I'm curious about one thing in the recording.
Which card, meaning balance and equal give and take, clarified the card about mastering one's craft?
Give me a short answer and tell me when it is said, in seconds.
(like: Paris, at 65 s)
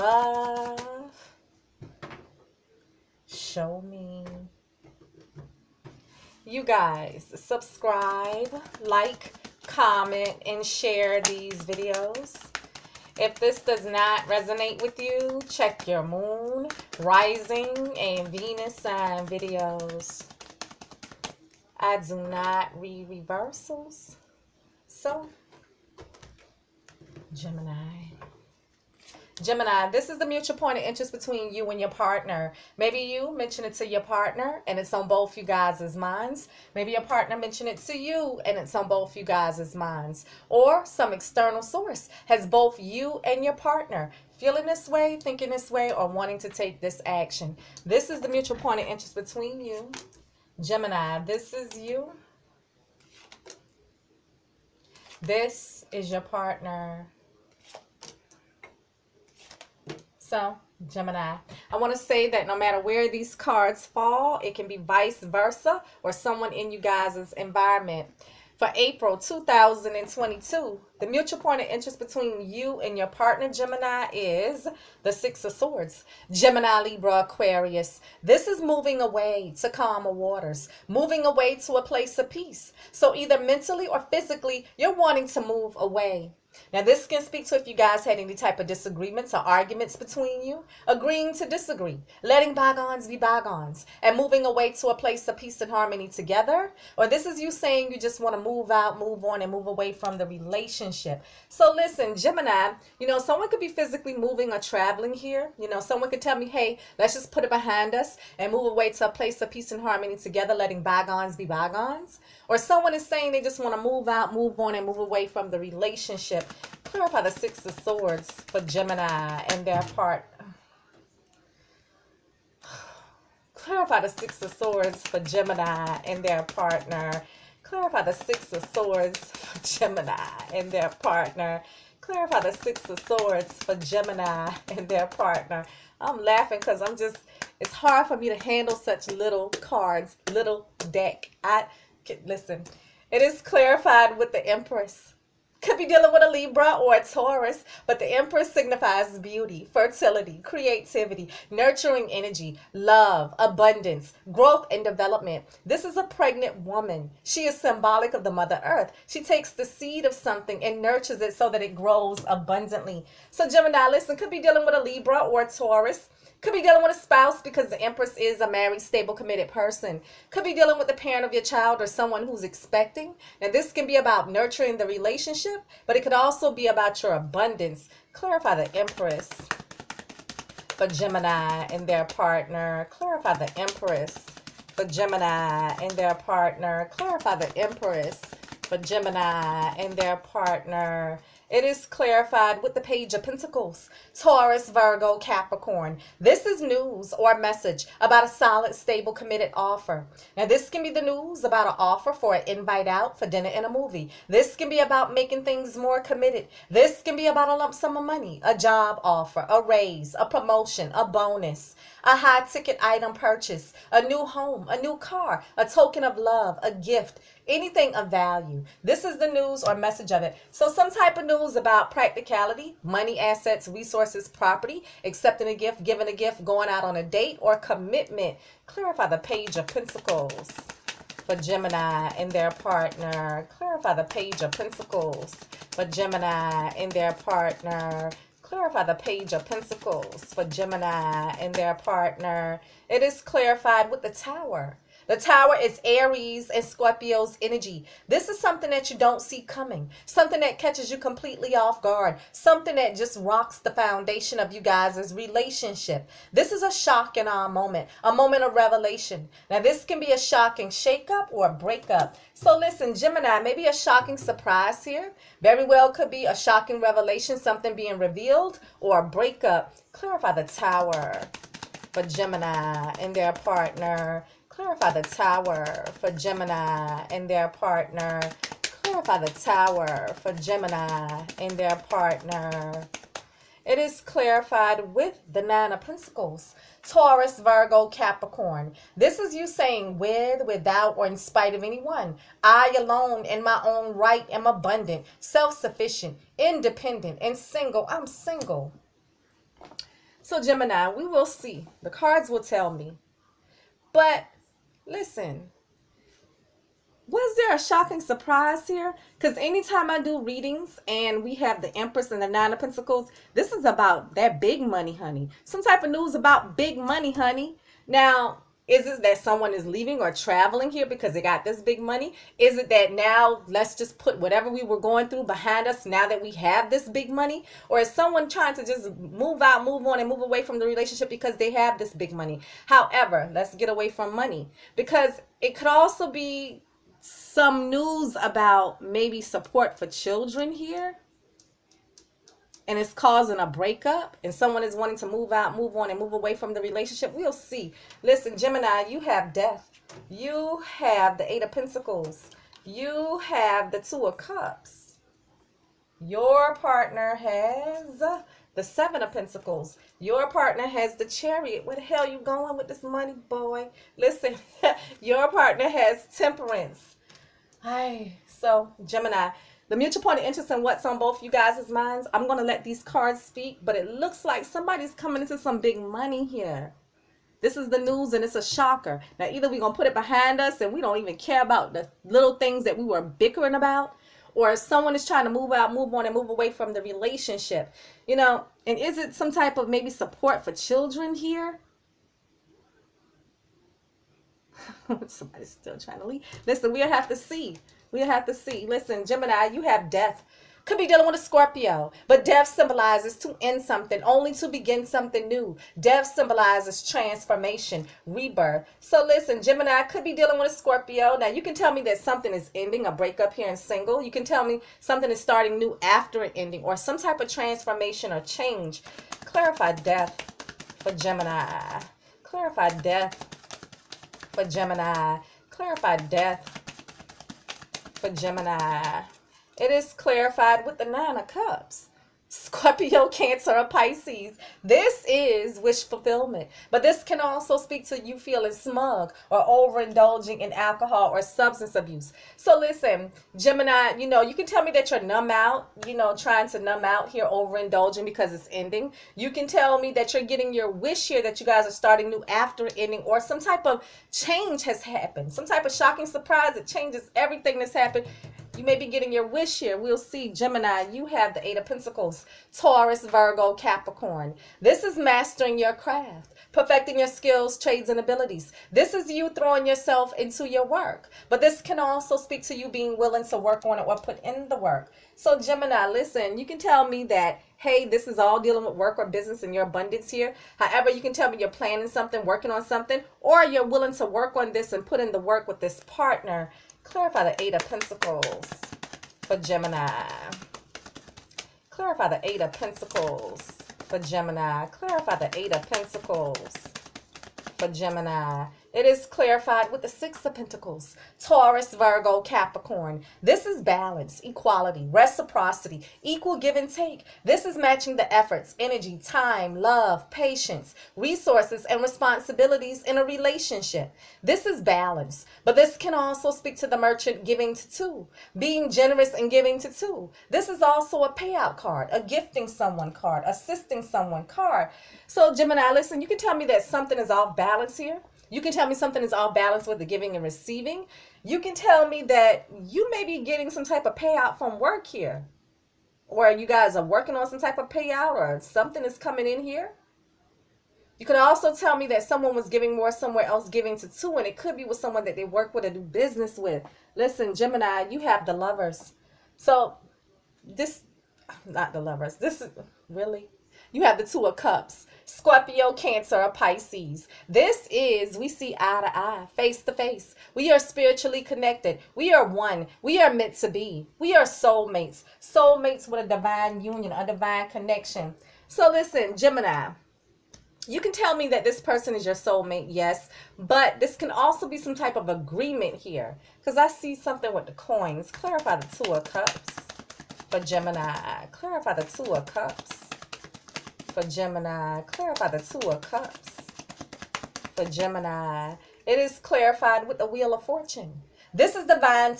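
Six of Pentacles, at 499 s.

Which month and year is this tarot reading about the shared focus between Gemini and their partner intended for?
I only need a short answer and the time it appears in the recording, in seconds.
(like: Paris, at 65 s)
April 2022, at 68 s.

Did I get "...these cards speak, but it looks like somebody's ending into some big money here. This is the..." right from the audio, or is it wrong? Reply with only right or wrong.
wrong.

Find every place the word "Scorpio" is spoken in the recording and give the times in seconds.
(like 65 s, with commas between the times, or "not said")
246 s, 401 s, 410 s, 432 s, 555 s.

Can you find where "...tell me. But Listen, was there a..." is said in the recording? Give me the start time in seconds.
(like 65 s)
302 s.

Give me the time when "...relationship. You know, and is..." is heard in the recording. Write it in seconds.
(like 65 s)
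386 s.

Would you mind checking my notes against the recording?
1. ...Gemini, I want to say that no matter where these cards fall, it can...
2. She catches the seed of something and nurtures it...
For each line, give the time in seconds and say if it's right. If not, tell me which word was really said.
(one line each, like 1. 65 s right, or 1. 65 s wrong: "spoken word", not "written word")
1. 60 s right
2. 159 s wrong: "takes", not "catches".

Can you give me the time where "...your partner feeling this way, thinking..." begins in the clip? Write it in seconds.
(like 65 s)
43 s.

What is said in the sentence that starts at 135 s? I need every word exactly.
I'm laughing because I'm just, it's hard for me to handle such little cards, little deck.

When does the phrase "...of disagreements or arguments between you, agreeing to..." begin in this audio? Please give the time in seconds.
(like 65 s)
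88 s.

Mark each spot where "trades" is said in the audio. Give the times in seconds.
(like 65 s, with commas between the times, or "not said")
467 s.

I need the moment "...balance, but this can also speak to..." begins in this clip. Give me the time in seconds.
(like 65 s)
514 s.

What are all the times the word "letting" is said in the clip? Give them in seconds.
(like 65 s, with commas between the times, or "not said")
92 s, 110 s.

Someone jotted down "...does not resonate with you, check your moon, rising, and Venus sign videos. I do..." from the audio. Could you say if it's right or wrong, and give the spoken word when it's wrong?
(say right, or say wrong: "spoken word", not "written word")
right.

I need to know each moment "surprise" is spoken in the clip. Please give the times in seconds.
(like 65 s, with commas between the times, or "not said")
264 s, 307 s, 456 s.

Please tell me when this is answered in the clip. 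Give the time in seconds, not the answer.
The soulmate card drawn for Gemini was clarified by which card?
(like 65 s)
590 s.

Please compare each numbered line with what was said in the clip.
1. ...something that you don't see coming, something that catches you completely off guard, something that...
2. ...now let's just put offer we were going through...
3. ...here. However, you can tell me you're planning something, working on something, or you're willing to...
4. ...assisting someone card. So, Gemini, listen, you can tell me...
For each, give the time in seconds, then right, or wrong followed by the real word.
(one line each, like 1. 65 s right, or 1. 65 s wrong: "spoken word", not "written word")
1. 248 s right
2. 322 s wrong: "whatever", not "offer"
3. 480 s right
4. 523 s right.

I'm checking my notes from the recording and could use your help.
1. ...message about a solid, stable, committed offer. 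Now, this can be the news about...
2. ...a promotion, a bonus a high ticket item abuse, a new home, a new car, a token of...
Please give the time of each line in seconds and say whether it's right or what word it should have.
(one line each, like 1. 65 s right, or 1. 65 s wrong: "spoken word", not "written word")
1. 197 s right
2. 210 s wrong: "purchase", not "abuse".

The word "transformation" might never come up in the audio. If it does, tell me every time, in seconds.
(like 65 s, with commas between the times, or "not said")
406 s, 417 s.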